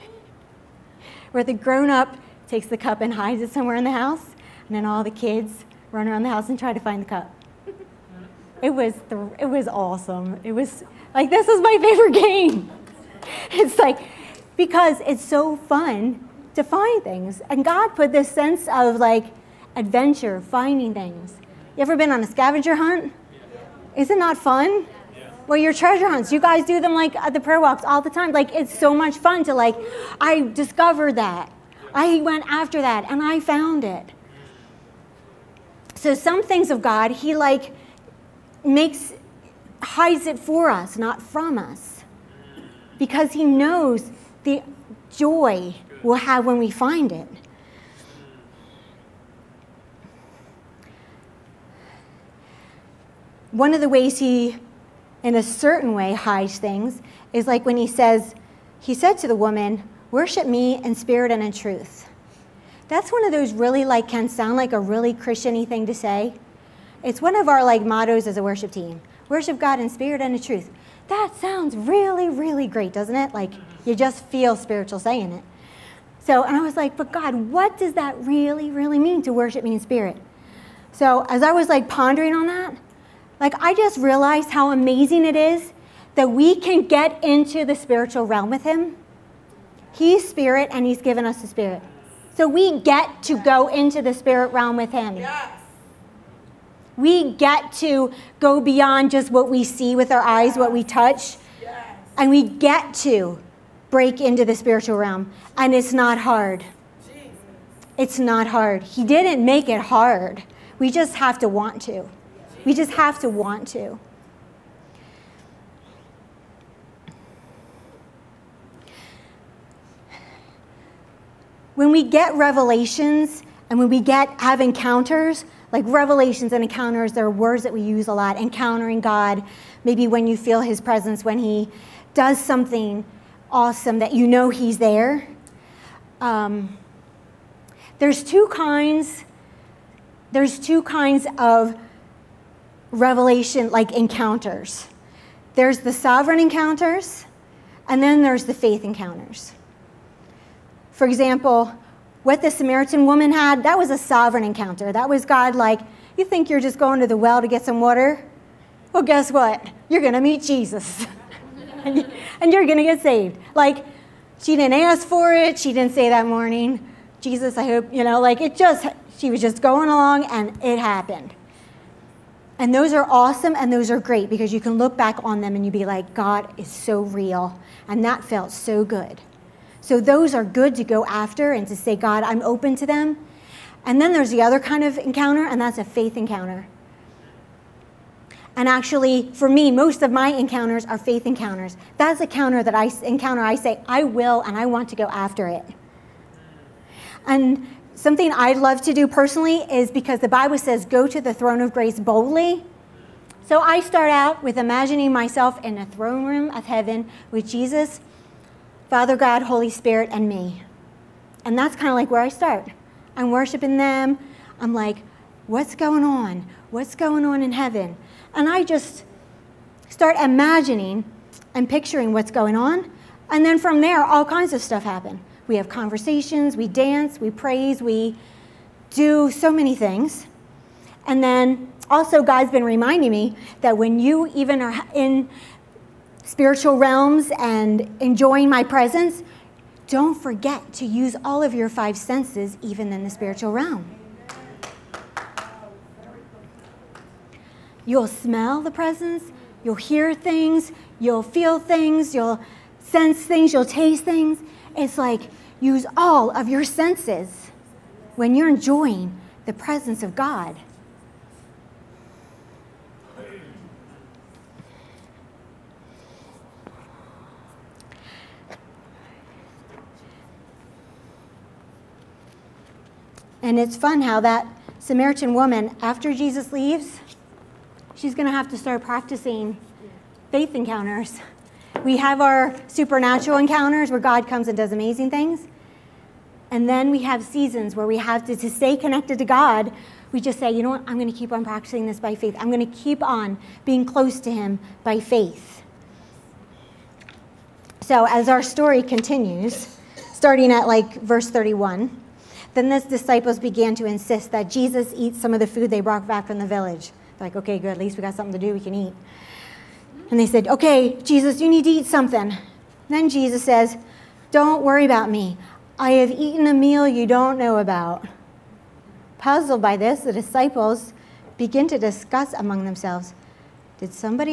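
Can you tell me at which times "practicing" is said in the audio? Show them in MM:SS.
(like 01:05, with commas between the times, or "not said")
04:38, 04:51.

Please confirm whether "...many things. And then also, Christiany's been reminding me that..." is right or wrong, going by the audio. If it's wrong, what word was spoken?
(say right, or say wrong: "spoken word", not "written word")
wrong: "God", not "Christiany".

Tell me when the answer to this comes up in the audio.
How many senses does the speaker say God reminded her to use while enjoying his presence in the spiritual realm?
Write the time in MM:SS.
04:01.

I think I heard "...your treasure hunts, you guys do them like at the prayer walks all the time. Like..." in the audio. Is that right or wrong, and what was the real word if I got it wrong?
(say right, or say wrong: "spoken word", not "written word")
right.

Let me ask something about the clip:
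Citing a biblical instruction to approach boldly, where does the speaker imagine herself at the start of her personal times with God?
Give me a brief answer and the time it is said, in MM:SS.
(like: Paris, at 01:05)
throne room of heaven, at 03:25.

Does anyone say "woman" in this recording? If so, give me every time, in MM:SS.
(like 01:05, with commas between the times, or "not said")
00:59, 02:33, 04:35.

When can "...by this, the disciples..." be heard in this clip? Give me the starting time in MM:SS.
05:19.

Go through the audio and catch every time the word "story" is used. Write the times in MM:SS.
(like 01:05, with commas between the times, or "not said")
04:58.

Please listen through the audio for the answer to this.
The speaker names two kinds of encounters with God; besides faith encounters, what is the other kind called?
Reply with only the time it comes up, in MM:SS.
02:25.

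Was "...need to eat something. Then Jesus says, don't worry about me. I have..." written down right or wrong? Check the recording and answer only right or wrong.
right.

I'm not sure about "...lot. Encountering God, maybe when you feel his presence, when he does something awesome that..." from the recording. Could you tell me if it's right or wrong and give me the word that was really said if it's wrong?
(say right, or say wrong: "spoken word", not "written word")
right.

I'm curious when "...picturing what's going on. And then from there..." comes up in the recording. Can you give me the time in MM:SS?
03:41.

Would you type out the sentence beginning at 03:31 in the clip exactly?
And that's kind of like where I start.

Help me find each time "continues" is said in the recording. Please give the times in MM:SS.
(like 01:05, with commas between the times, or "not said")
04:58.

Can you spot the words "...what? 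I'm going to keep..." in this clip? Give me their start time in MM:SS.
04:50.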